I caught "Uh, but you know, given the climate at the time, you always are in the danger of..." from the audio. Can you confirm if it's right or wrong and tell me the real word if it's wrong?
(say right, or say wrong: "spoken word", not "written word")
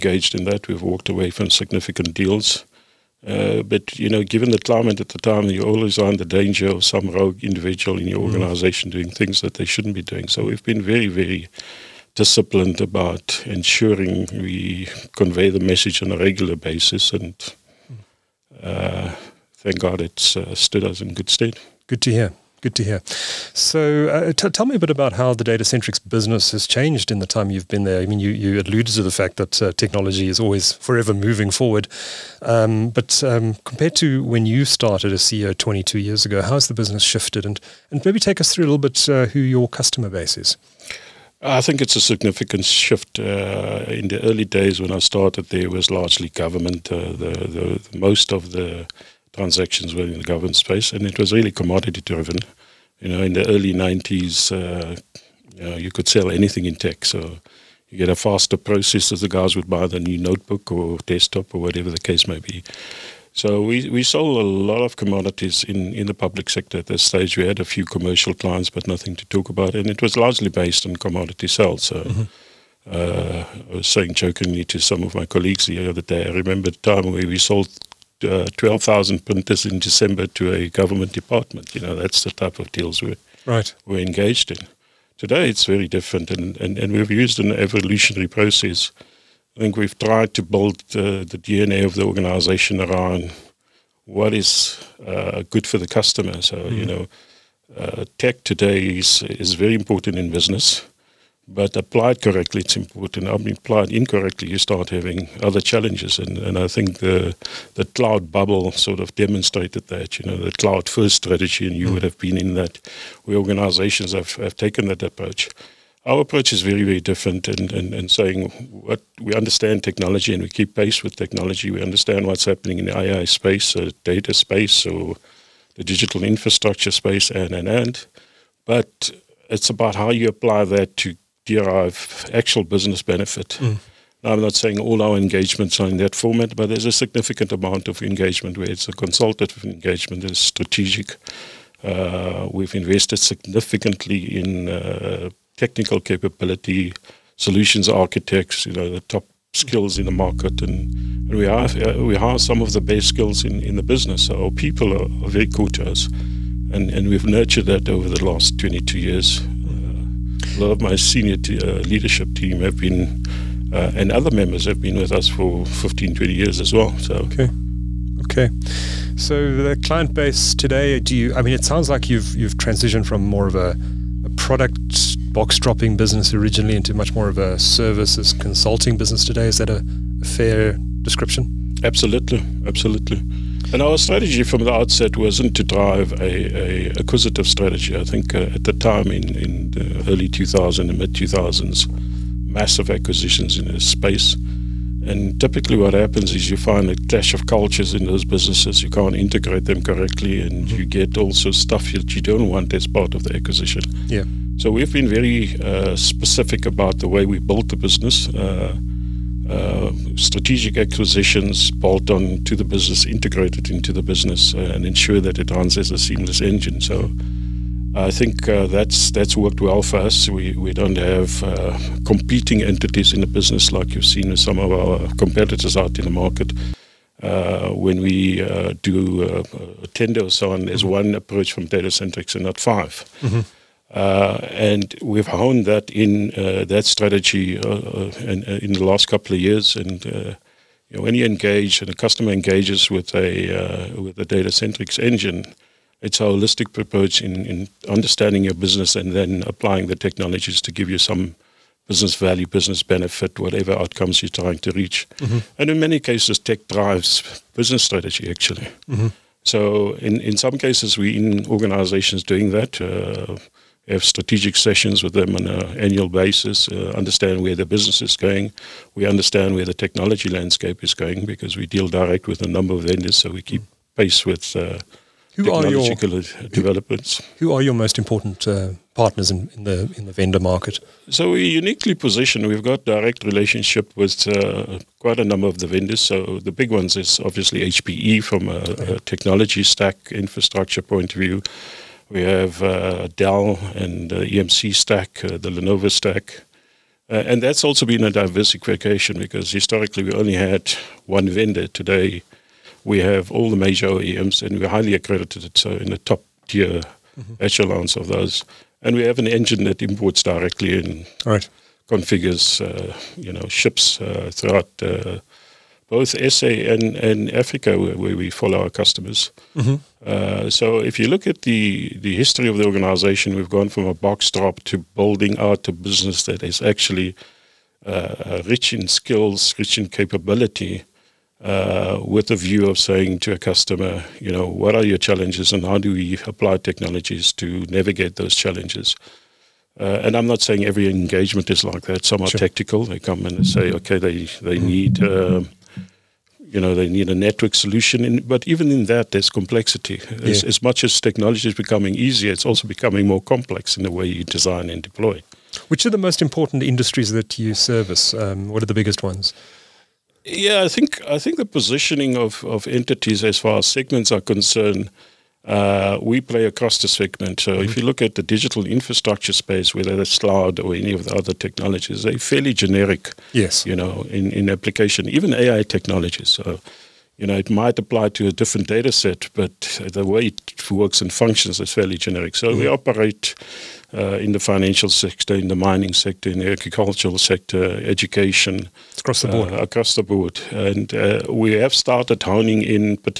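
right.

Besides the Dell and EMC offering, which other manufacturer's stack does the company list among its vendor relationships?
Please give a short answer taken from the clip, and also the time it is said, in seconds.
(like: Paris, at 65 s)
Lenovo, at 295 s.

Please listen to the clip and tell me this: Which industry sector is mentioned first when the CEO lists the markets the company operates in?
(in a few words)
Financial sector.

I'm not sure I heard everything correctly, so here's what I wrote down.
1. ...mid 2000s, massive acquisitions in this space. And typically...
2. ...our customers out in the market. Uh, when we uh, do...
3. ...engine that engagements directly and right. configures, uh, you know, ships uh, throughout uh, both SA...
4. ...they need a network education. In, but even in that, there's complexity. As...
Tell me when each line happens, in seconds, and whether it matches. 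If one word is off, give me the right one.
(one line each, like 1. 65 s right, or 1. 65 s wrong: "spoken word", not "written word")
1. 190 s right
2. 224 s wrong: "competitors", not "customers"
3. 309 s wrong: "imports", not "engagements"
4. 346 s wrong: "solution", not "education".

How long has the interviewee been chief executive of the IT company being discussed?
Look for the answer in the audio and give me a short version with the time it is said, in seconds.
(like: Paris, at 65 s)
22 years, at 35 s.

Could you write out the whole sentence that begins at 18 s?
uh, thank God it's uh, stood us in good stead.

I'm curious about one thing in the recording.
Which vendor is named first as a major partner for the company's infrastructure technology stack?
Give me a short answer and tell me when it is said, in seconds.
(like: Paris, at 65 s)
HPE, at 287 s.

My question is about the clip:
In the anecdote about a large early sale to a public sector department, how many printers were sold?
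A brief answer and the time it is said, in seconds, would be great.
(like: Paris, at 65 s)
12,000, at 78 s.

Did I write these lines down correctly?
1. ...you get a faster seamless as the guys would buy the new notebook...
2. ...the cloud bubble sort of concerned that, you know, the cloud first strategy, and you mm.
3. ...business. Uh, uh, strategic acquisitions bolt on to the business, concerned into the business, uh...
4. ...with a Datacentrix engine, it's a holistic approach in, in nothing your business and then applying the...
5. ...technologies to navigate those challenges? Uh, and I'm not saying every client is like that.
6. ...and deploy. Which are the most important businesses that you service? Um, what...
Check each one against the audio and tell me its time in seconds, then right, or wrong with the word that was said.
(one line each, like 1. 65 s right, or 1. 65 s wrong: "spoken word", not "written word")
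1. 57 s wrong: "process", not "seamless"
2. 107 s wrong: "demonstrated", not "concerned"
3. 207 s wrong: "integrated", not "concerned"
4. 243 s wrong: "understanding", not "nothing"
5. 336 s wrong: "engagement", not "client"
6. 354 s wrong: "industries", not "businesses".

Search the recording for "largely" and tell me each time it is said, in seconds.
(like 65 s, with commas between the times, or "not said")
45 s, 70 s.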